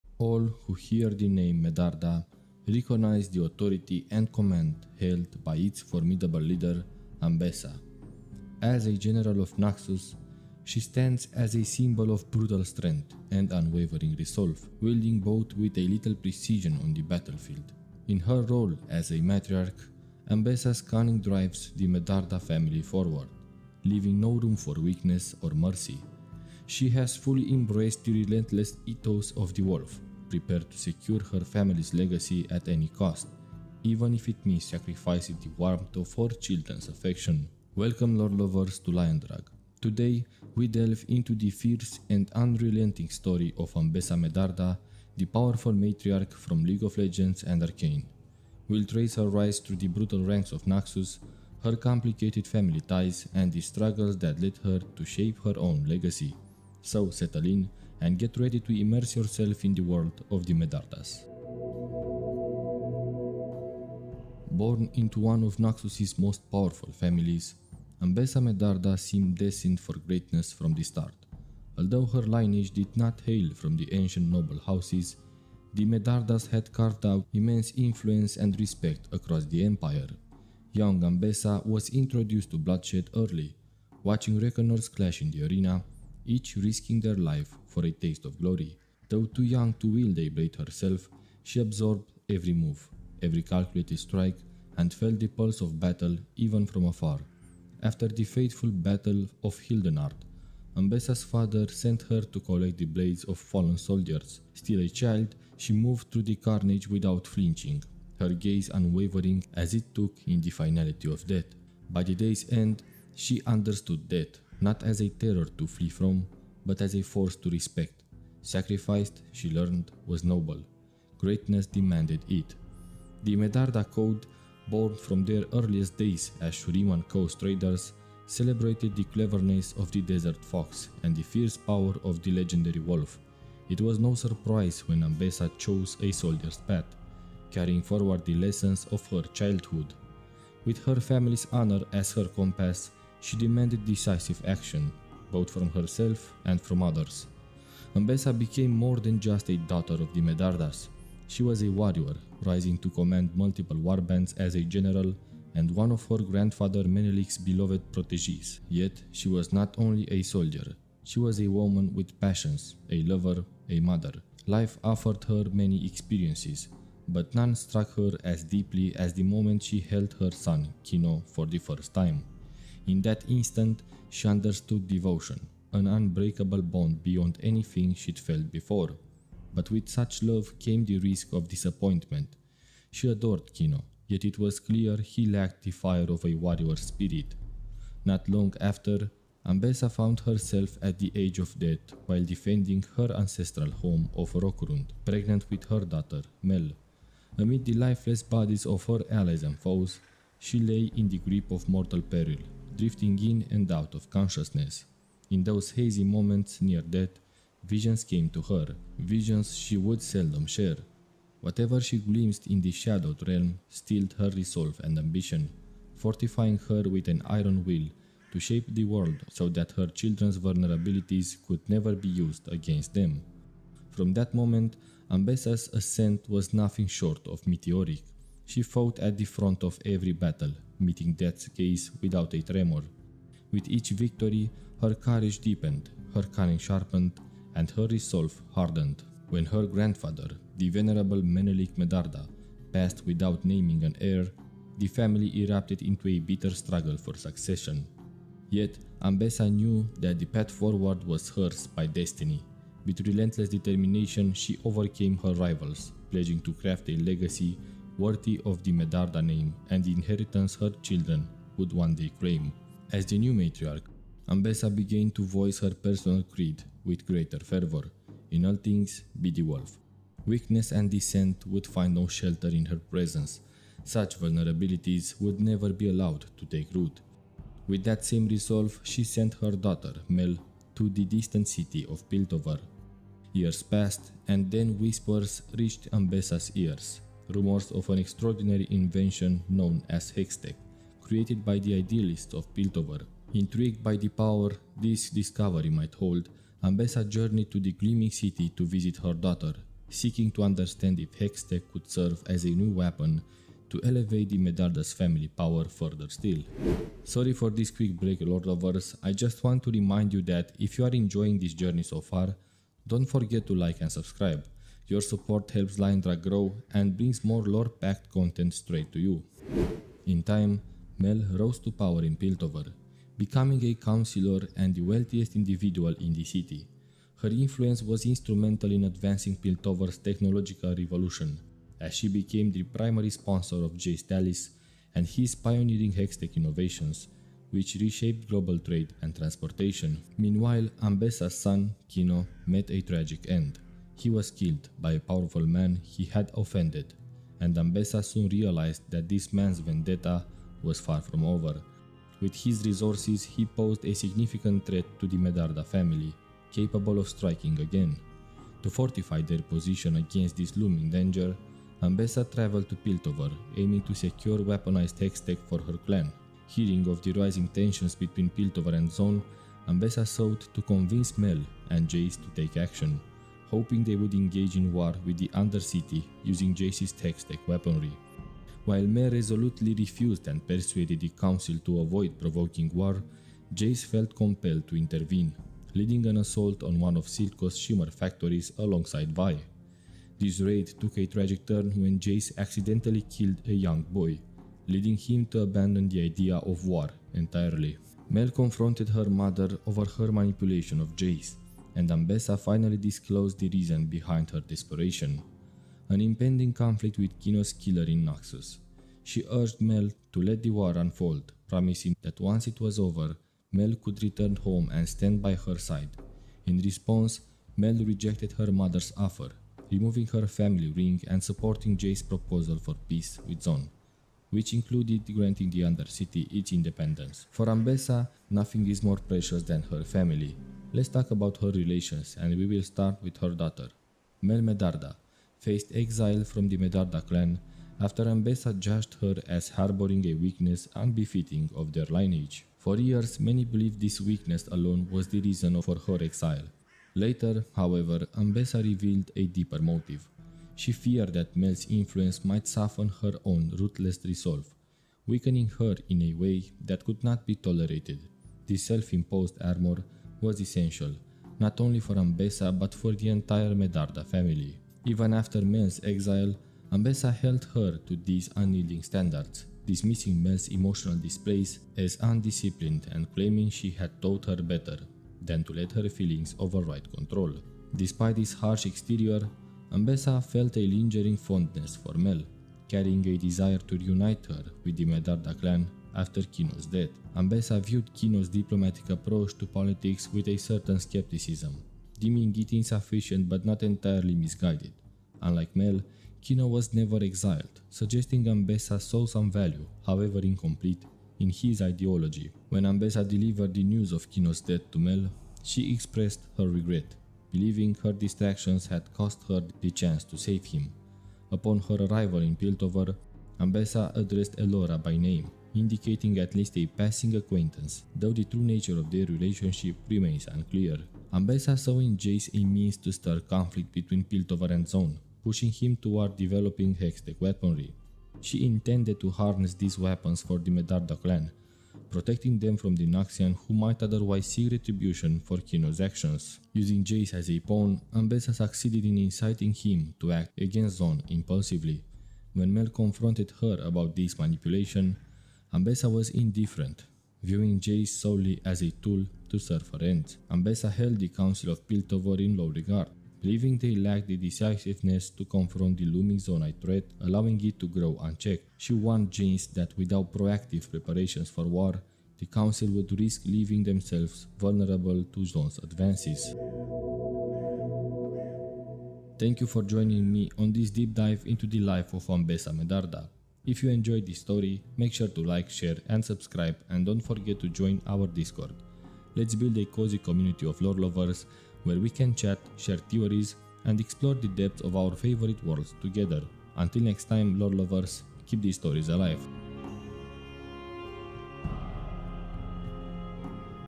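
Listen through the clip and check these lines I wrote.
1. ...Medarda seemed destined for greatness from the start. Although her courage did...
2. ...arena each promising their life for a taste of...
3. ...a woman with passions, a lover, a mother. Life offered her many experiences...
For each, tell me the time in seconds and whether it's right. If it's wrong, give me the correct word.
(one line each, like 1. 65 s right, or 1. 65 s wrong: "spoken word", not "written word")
1. 68 s wrong: "lineage", not "courage"
2. 85 s wrong: "risking", not "promising"
3. 161 s right.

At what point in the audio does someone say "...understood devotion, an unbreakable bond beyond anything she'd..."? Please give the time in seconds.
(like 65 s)
174 s.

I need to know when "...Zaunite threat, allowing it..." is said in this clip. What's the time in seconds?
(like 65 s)
556 s.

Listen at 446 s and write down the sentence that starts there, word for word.
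Later, however, Ambessa revealed a deeper motive.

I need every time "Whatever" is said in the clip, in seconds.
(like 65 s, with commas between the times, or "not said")
211 s.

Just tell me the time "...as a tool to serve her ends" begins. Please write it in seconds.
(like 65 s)
548 s.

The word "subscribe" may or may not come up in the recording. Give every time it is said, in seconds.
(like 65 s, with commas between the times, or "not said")
313 s, 576 s.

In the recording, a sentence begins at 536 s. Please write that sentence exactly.
Using Jayce as a pawn, Ambessa succeeded in inciting him to act against Zaun impulsively.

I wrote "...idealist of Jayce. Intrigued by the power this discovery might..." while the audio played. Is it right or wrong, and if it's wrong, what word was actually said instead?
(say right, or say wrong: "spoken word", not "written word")
wrong: "Piltover", not "Jayce".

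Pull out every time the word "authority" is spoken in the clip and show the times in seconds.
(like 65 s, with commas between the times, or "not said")
3 s.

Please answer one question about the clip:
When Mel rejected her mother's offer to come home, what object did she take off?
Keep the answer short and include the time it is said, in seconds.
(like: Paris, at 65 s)
Family ring, at 420 s.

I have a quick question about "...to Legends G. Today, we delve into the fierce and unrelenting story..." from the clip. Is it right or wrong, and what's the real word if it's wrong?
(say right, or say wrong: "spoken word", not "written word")
wrong: "Liandru", not "Legends".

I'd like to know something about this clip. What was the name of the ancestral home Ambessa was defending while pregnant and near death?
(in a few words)
Rokurund.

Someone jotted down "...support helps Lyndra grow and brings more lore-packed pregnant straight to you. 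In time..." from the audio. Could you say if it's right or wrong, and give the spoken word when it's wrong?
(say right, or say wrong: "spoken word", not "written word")
wrong: "content", not "pregnant".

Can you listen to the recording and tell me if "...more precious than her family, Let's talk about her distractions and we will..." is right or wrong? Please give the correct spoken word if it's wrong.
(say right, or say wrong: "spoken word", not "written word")
wrong: "relations", not "distractions".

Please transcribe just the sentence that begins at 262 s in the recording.
As the new matriarch, Ambessa began to voice her personal creed with greater fervor.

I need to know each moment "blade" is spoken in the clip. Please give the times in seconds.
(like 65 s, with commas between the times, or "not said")
90 s, 102 s.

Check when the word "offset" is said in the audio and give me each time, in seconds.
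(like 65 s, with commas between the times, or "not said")
not said.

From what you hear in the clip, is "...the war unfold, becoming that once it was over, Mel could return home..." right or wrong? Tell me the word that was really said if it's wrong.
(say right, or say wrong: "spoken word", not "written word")
wrong: "promising", not "becoming".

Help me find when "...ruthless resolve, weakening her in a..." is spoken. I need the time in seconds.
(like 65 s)
453 s.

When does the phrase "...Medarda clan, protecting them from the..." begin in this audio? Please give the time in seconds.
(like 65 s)
530 s.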